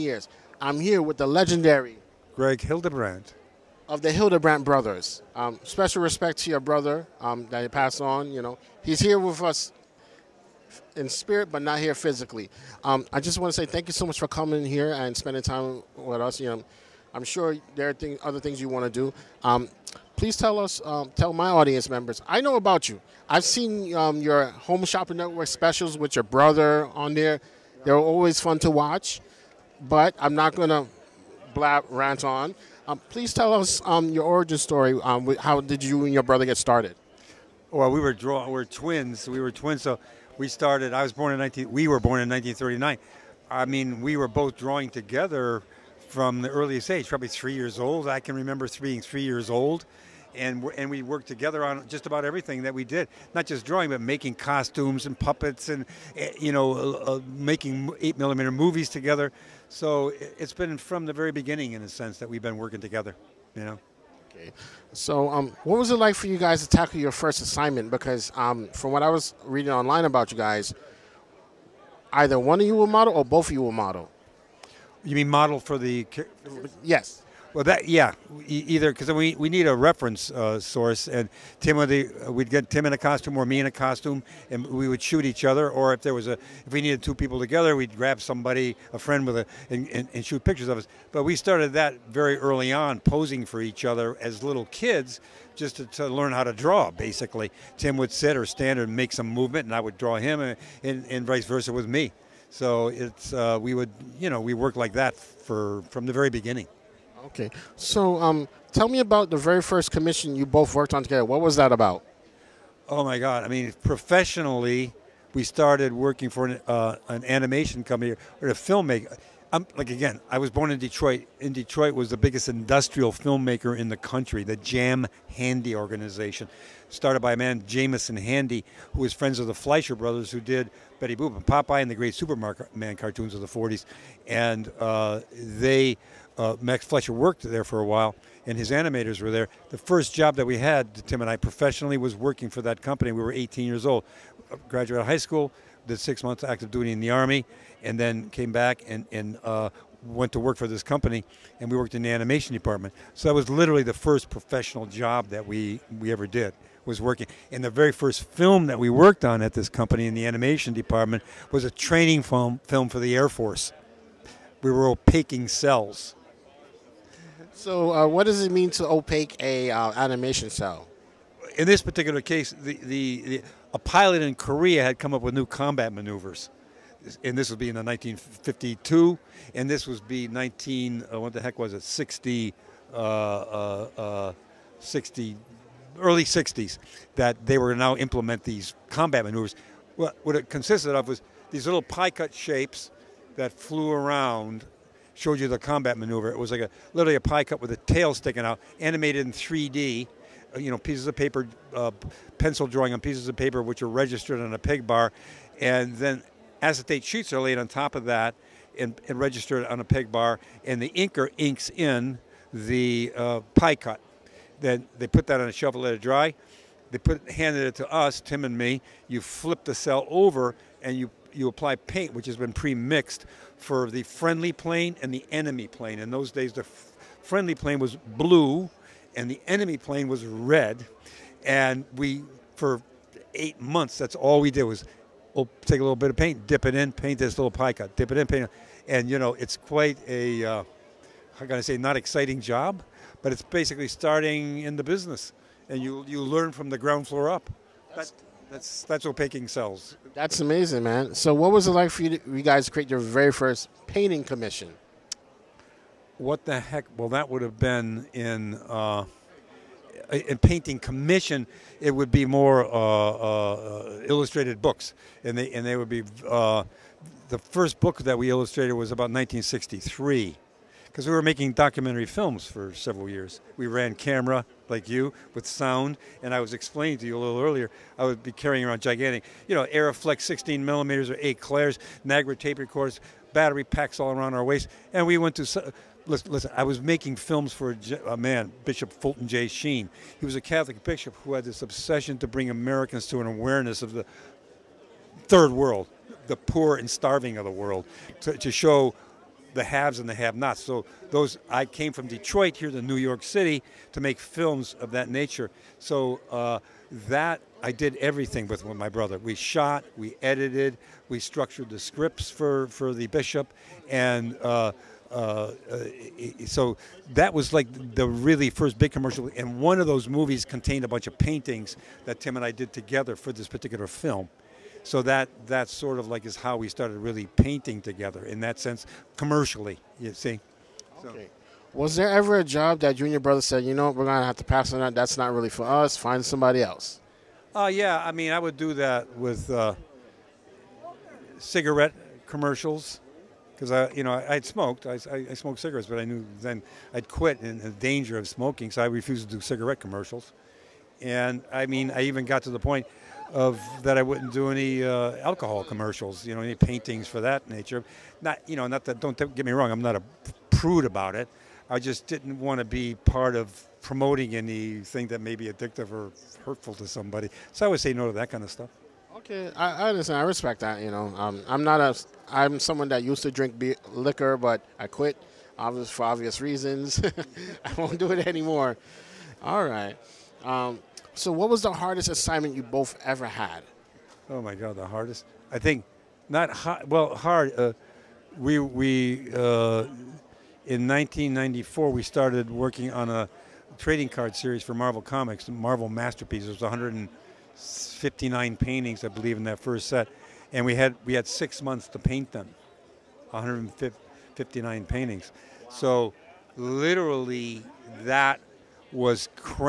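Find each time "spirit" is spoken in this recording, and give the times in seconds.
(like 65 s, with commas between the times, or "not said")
11 s.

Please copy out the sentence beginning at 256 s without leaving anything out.
Well, that would have been in uh, in painting commission.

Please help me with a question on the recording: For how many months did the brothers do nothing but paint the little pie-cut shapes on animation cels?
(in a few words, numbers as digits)
8.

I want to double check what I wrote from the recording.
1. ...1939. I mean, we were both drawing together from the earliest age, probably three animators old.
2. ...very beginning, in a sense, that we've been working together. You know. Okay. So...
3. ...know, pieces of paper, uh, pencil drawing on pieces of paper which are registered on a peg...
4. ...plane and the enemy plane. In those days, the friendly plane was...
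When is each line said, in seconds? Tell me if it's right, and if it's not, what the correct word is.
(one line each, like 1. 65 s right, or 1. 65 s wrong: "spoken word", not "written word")
1. 42 s wrong: "years", not "animators"
2. 61 s right
3. 200 s right
4. 224 s right.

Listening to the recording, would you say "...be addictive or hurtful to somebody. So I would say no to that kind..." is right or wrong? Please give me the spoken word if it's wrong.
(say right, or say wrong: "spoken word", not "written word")
right.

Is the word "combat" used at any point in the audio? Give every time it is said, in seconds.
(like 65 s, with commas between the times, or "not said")
175 s, 188 s, 195 s.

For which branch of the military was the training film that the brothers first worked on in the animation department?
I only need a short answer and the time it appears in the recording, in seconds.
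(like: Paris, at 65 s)
Air Force, at 163 s.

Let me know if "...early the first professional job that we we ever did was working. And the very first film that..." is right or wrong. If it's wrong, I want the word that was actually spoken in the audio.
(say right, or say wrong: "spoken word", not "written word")
wrong: "literally", not "early".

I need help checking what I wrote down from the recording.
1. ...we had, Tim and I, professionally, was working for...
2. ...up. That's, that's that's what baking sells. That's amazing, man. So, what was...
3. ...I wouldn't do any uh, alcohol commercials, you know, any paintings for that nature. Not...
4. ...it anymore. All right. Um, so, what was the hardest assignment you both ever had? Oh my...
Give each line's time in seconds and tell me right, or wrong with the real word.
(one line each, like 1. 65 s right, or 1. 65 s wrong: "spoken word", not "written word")
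1. 140 s right
2. 247 s right
3. 353 s right
4. 378 s right.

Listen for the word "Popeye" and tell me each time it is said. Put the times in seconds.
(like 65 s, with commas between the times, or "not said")
131 s.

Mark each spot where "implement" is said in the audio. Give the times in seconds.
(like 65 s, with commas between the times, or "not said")
187 s.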